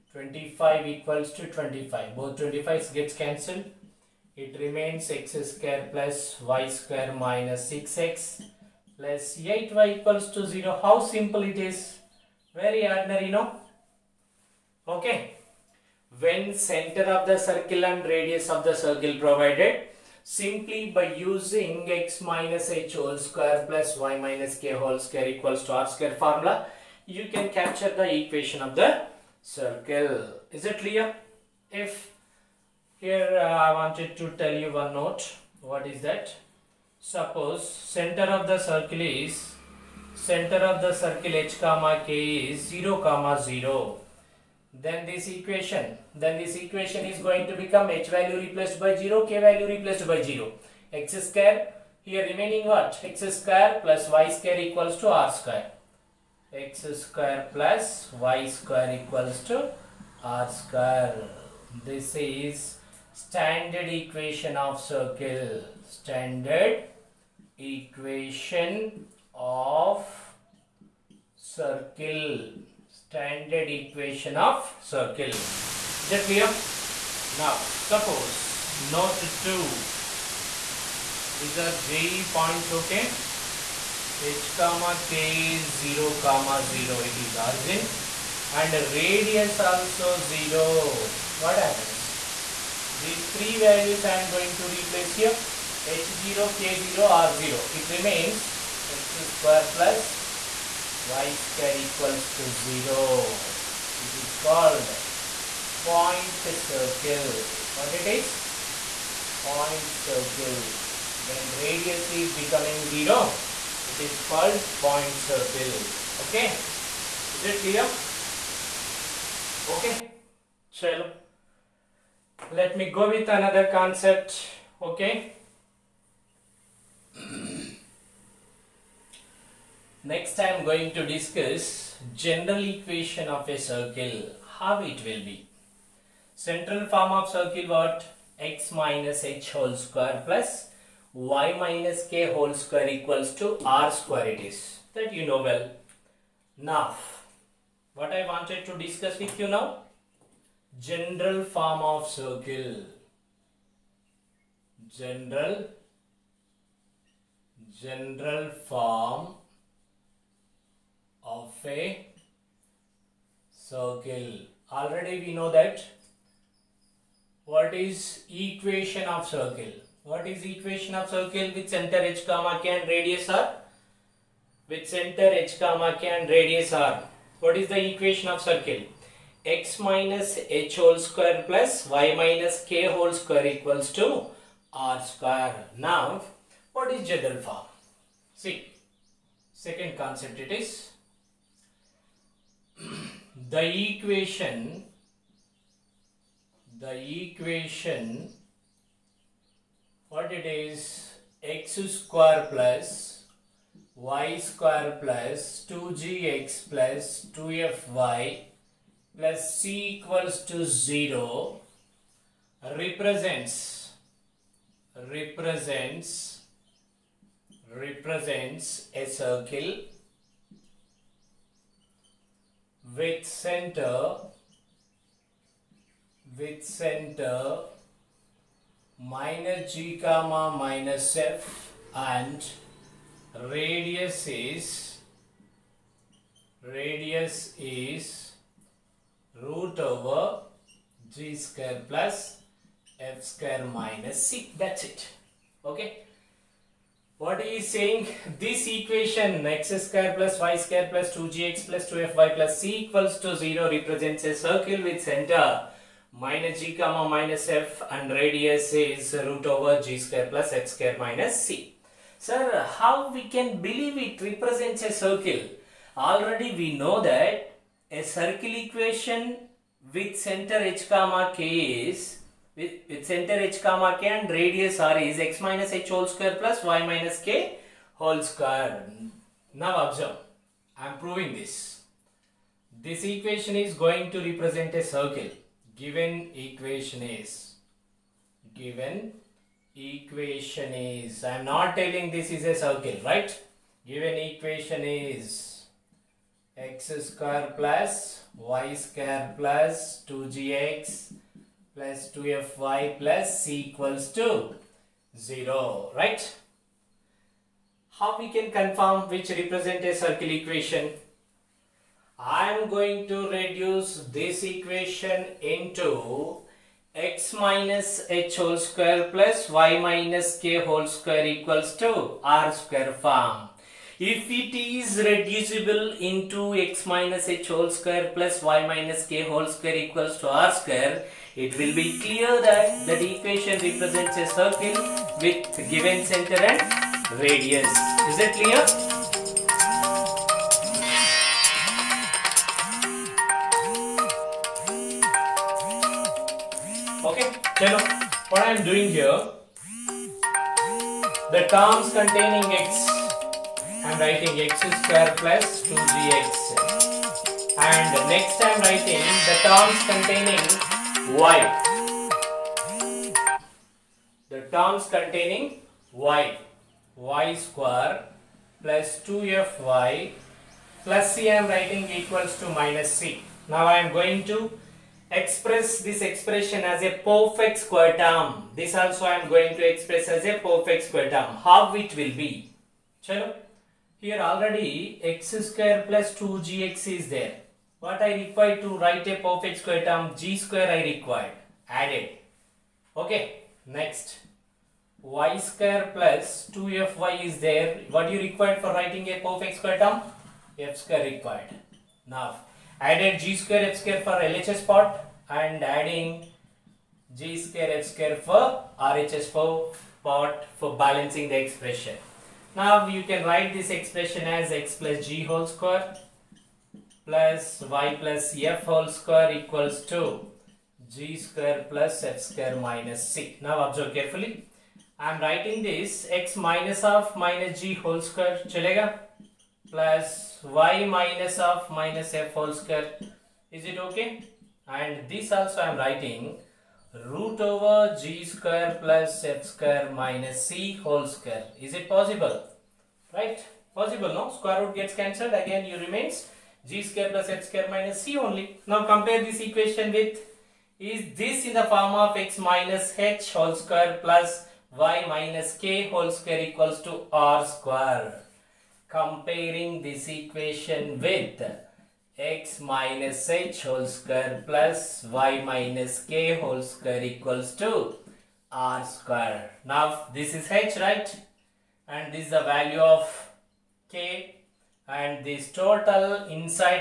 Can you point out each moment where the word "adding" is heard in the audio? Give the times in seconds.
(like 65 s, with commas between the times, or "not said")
405 s.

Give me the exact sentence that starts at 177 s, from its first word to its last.
What is the equation of circle?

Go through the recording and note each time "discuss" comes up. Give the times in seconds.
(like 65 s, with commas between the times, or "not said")
131 s, 148 s.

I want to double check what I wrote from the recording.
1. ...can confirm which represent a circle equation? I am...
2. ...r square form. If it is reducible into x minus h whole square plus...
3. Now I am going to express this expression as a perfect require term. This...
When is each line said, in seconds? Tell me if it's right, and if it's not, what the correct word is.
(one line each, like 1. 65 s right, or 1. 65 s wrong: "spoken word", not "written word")
1. 308 s right
2. 322 s right
3. 373 s wrong: "square", not "require".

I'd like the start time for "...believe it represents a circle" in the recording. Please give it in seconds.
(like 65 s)
263 s.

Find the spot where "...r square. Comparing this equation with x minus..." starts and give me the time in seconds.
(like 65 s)
457 s.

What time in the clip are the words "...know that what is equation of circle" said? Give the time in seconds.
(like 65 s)
165 s.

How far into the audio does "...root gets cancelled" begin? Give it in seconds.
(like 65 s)
444 s.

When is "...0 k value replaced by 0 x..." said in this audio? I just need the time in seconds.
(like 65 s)
48 s.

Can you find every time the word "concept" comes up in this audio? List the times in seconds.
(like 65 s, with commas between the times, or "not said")
123 s, 189 s.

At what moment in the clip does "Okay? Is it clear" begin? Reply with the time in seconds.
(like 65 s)
116 s.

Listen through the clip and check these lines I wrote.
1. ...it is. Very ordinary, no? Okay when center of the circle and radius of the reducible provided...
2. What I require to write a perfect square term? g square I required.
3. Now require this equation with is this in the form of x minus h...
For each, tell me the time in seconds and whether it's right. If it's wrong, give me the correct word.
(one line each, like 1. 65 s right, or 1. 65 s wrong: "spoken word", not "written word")
1. 11 s wrong: "circle", not "reducible"
2. 387 s right
3. 448 s wrong: "compare", not "require".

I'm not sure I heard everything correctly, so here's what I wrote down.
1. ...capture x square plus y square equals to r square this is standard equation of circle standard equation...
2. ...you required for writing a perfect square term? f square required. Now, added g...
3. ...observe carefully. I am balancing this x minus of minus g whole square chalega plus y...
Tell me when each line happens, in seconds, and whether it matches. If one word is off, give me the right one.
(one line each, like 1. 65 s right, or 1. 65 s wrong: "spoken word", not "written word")
1. 55 s wrong: "square", not "capture"
2. 398 s right
3. 423 s wrong: "writing", not "balancing".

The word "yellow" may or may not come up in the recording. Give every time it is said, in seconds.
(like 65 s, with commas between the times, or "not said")
not said.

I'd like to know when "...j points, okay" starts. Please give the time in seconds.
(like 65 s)
81 s.